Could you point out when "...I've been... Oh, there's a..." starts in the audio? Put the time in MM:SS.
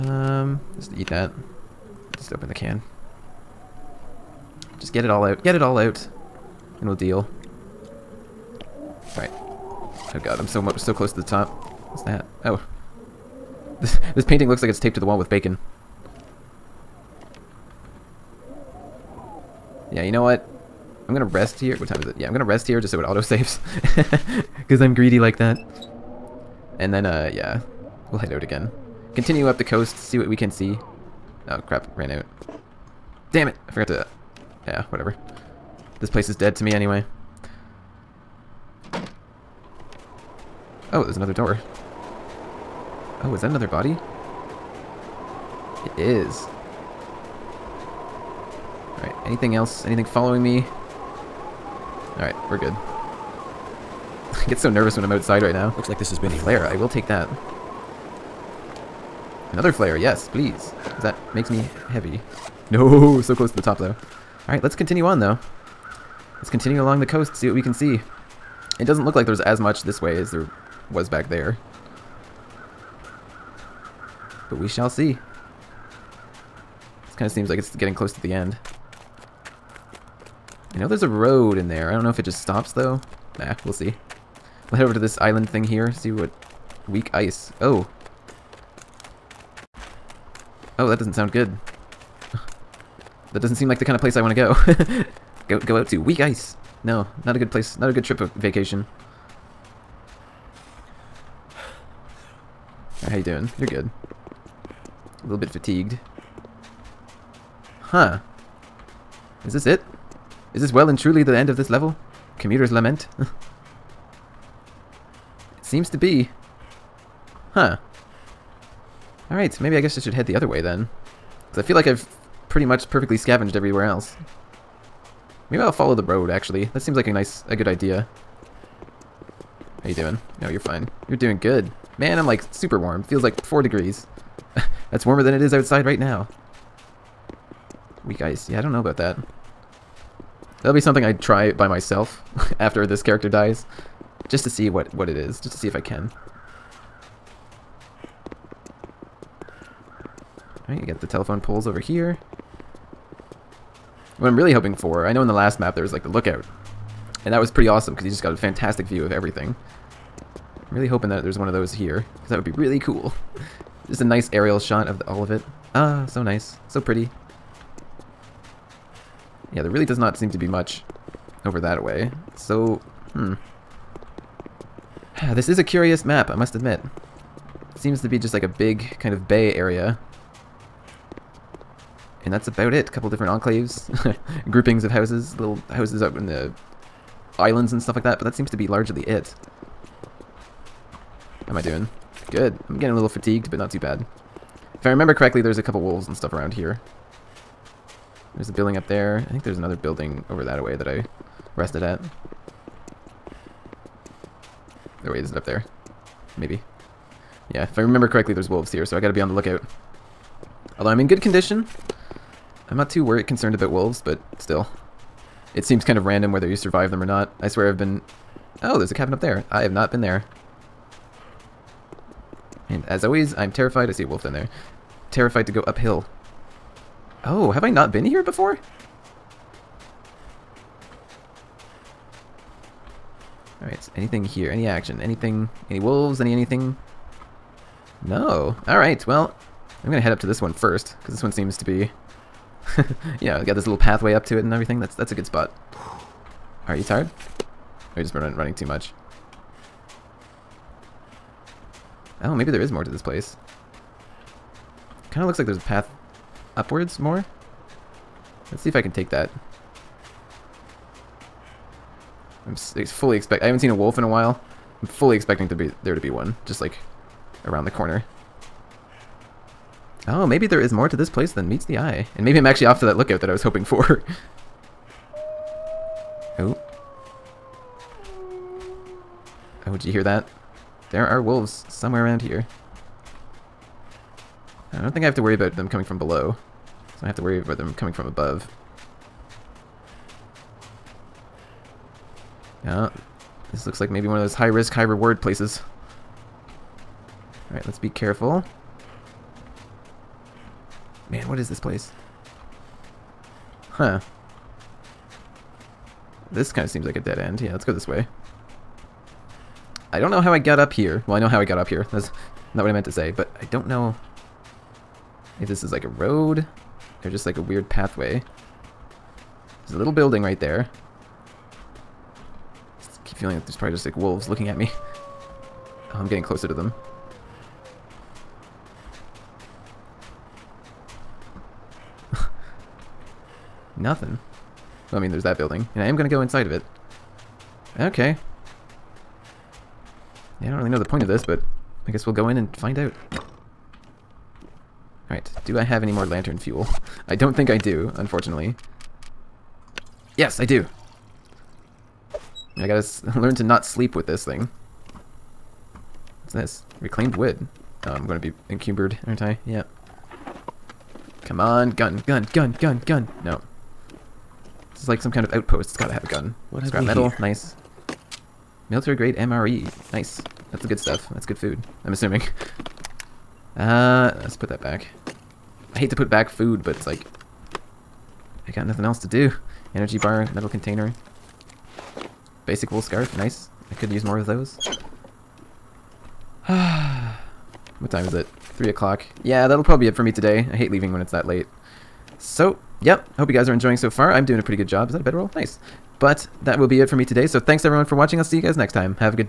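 03:37.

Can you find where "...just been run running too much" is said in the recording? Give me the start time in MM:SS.
04:08.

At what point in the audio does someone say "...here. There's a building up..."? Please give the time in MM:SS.
03:16.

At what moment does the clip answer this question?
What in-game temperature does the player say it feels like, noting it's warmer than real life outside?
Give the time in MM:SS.
02:13.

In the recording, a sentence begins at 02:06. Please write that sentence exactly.
That seems like a nice, a good idea.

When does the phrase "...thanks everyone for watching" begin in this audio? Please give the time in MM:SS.
06:37.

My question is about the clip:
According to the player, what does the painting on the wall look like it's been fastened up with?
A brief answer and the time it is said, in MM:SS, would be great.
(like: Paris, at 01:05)
bacon, at 00:15.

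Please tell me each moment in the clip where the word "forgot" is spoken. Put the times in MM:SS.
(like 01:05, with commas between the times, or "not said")
00:33.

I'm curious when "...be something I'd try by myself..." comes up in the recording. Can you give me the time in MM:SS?
02:20.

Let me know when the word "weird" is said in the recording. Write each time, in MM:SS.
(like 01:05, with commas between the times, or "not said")
05:17.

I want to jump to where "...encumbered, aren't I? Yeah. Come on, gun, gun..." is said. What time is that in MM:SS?
05:58.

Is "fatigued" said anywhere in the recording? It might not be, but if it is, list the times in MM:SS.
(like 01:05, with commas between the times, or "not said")
01:45, 03:13.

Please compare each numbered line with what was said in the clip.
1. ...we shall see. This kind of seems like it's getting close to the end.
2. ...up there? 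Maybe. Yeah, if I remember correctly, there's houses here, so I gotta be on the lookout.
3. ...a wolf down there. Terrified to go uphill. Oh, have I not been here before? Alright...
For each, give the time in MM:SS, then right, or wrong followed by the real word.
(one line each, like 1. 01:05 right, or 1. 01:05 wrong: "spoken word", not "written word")
1. 01:14 right
2. 03:25 wrong: "wolves", not "houses"
3. 03:44 right.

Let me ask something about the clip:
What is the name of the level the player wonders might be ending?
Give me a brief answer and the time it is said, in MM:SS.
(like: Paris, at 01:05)
Commuter's lament, at 01:52.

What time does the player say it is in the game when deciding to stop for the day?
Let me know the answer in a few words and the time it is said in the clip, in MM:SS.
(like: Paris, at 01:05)
3 o'clock, at 06:28.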